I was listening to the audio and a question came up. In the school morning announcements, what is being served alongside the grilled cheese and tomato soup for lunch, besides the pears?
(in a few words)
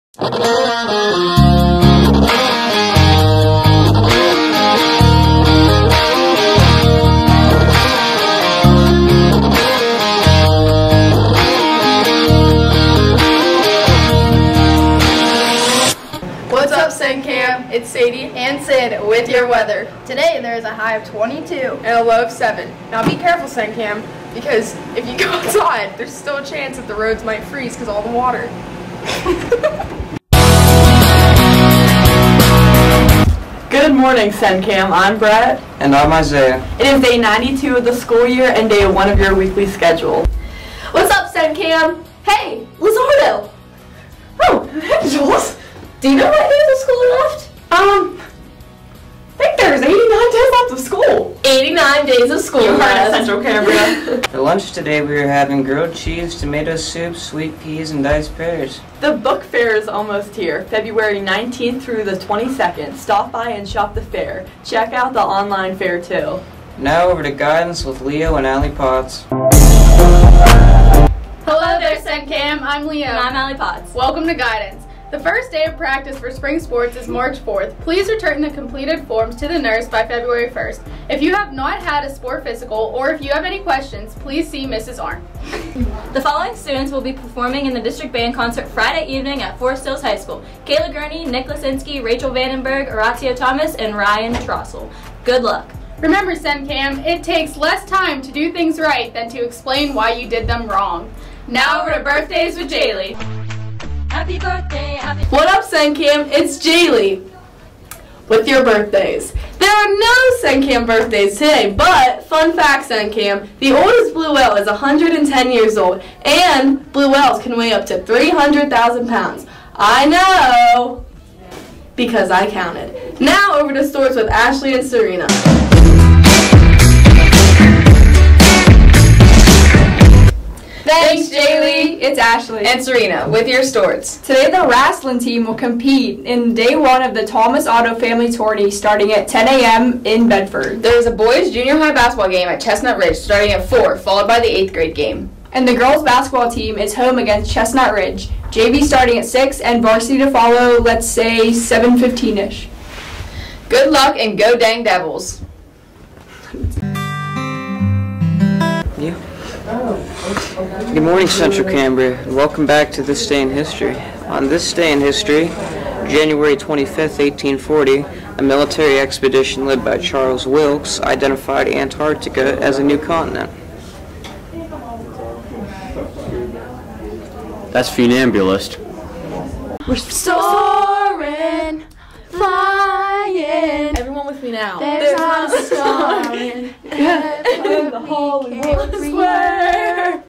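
sweet peas.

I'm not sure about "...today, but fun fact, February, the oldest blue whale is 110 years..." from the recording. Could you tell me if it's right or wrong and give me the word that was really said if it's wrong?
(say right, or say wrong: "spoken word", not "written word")
wrong: "Sencam", not "February".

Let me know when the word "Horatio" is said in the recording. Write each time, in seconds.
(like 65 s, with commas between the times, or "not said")
92 s.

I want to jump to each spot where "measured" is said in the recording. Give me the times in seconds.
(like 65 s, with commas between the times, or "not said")
not said.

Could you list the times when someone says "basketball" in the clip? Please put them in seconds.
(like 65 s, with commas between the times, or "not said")
141 s, 146 s.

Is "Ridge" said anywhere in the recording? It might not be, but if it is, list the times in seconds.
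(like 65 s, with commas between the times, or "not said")
142 s, 147 s.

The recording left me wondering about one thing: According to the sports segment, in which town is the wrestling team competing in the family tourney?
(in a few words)
Bedford.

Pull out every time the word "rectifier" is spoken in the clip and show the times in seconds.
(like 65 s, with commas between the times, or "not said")
not said.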